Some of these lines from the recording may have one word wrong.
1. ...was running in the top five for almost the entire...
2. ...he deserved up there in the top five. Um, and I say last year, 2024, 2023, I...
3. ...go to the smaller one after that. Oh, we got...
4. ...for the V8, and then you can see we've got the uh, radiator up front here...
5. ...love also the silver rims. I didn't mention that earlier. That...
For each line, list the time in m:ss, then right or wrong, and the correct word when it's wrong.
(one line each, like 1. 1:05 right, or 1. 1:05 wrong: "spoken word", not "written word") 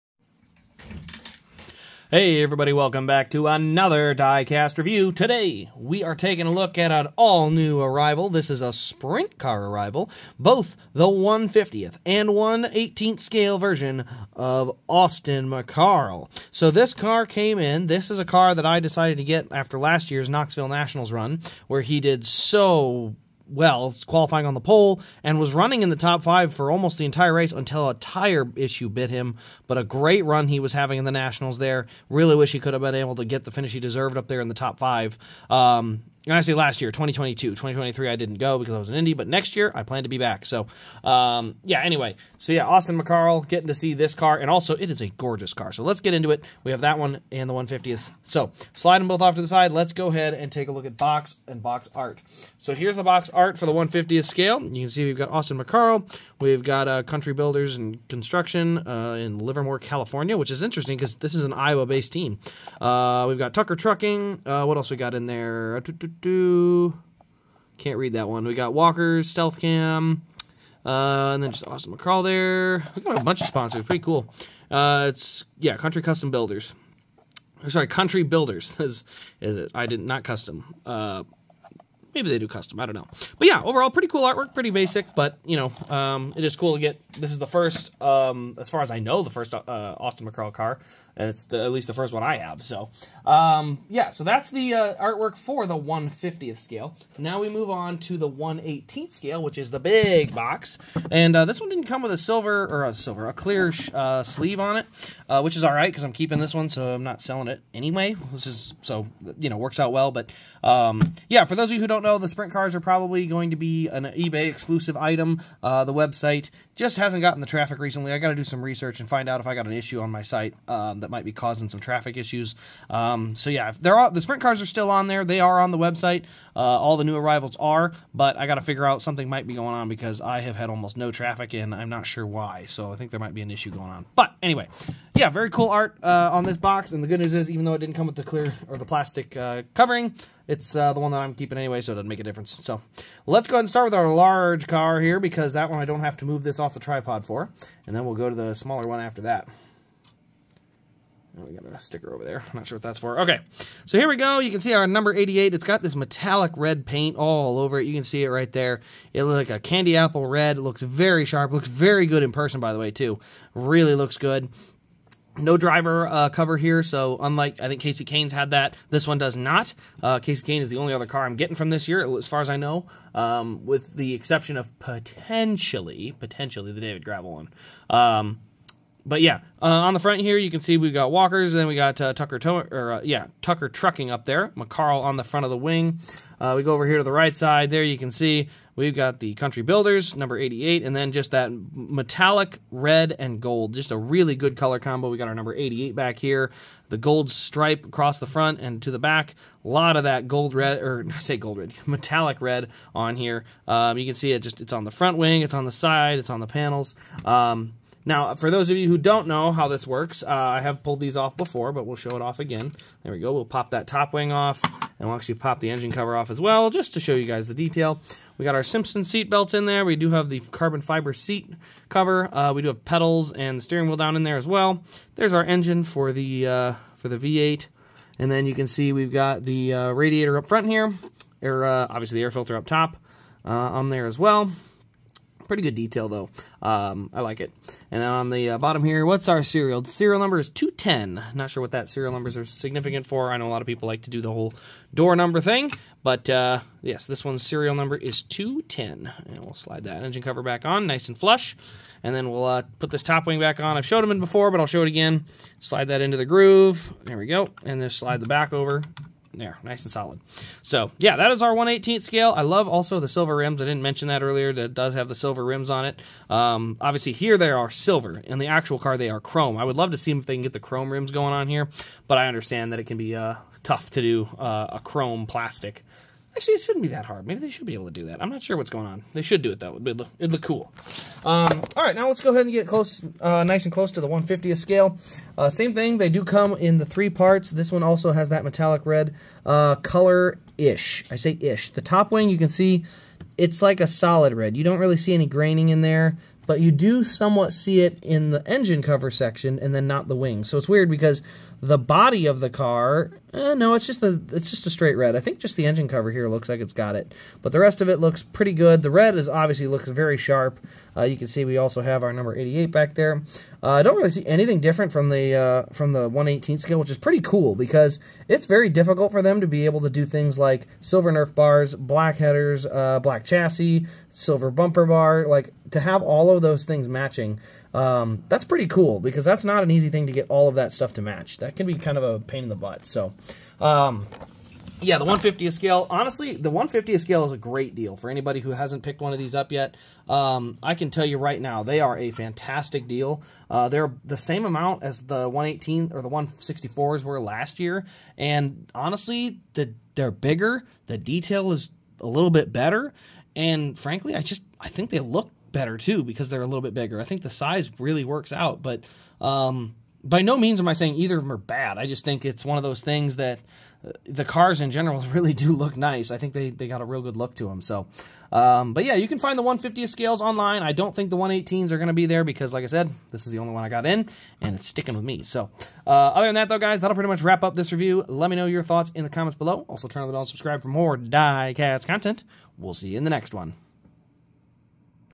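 1. 0:25 right
2. 0:33 wrong: "2022", not "2024"
3. 2:28 right
4. 3:46 right
5. 4:22 right.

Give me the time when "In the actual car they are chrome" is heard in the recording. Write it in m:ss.
4:28.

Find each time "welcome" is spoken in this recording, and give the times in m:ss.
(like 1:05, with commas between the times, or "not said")
0:02.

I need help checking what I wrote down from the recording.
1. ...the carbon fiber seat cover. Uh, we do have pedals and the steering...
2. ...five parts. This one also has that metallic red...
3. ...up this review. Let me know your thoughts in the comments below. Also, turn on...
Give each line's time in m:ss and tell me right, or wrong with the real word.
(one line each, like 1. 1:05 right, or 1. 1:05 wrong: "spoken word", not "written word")
1. 3:40 right
2. 4:46 wrong: "three", not "five"
3. 6:17 right.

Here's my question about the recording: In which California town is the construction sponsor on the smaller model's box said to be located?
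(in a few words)
Livermore.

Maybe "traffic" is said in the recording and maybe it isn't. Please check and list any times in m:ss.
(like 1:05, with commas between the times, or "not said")
1:57, 2:01, 2:11.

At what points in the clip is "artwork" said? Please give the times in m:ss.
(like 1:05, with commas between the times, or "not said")
1:24, 1:34.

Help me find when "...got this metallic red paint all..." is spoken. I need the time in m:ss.
2:35.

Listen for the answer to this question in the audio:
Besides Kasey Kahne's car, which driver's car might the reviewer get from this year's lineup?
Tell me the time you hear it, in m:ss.
2:56.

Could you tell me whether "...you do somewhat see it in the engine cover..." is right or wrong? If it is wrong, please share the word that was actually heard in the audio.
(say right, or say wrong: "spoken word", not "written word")
right.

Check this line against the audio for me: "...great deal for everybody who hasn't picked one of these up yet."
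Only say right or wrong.
wrong.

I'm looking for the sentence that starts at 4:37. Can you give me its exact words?
Maybe they should be able to do that.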